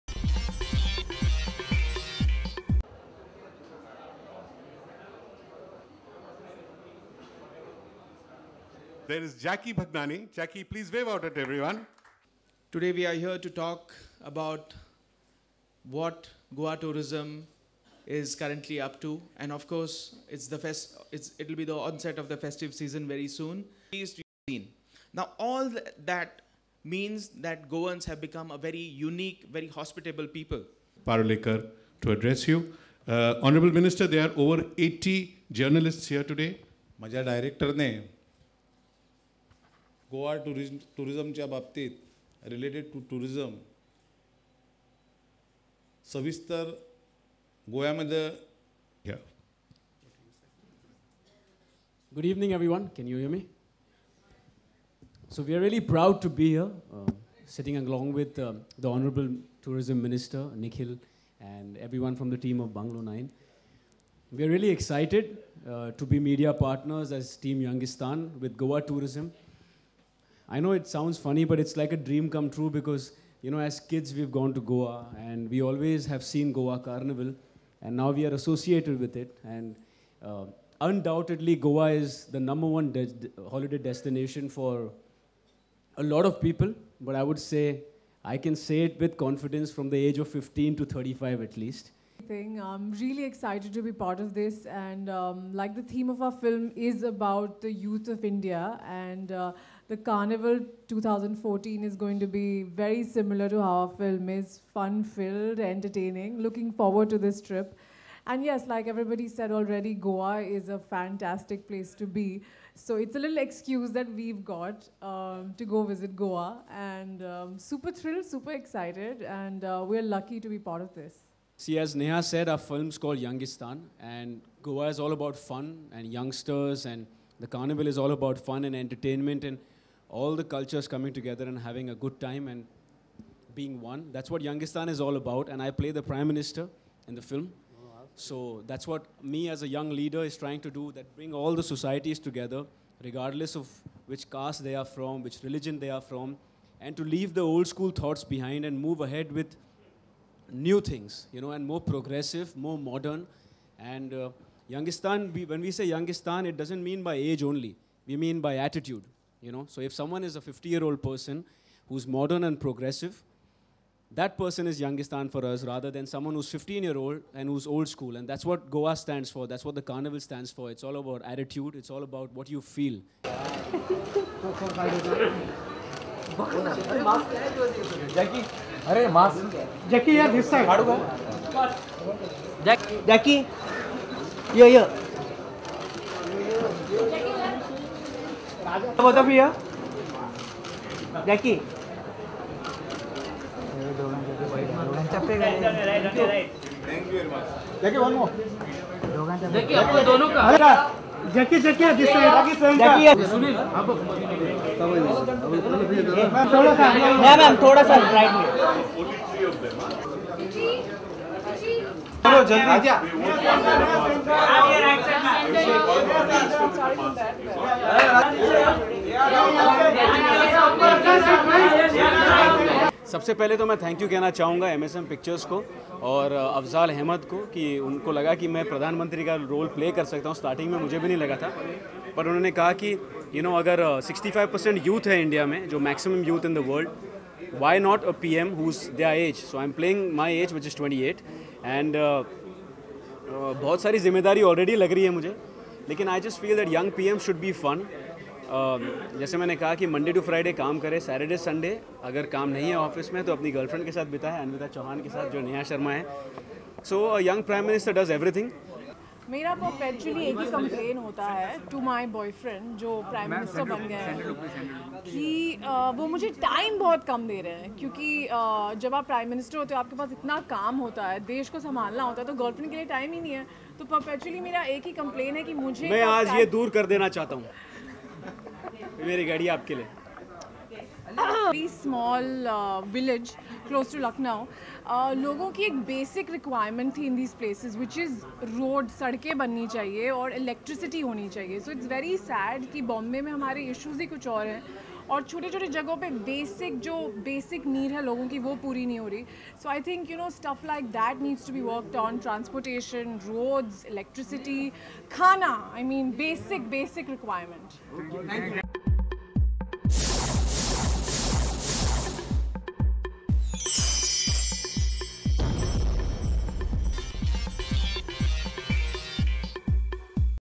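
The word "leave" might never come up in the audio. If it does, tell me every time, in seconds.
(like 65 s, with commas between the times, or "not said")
147 s.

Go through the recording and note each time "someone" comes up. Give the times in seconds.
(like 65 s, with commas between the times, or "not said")
159 s, 166 s.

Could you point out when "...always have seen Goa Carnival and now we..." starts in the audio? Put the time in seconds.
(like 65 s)
75 s.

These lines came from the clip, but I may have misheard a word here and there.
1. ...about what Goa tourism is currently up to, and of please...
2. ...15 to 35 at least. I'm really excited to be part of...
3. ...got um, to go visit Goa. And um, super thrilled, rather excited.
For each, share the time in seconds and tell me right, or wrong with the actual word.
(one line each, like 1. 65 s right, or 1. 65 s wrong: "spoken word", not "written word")
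1. 14 s wrong: "course", not "please"
2. 90 s right
3. 114 s wrong: "super", not "rather".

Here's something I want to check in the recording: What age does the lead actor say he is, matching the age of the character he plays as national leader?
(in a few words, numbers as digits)
28.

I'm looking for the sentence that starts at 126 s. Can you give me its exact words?
And the carnival is all about fun and entertainment.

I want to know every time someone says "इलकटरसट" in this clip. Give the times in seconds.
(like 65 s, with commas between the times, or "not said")
290 s, 303 s.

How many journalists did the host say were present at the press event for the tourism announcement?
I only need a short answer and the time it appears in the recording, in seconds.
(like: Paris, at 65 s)
80, at 34 s.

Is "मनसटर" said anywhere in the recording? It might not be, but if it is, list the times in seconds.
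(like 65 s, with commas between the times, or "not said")
257 s, 263 s, 269 s.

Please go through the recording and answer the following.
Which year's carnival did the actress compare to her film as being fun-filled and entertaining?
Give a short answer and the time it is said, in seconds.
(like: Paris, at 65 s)
2014, at 100 s.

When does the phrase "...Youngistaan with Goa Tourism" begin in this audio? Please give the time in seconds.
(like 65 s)
67 s.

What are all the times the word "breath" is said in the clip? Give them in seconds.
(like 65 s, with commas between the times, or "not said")
not said.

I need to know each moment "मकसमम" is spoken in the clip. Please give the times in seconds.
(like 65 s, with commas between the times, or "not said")
235 s.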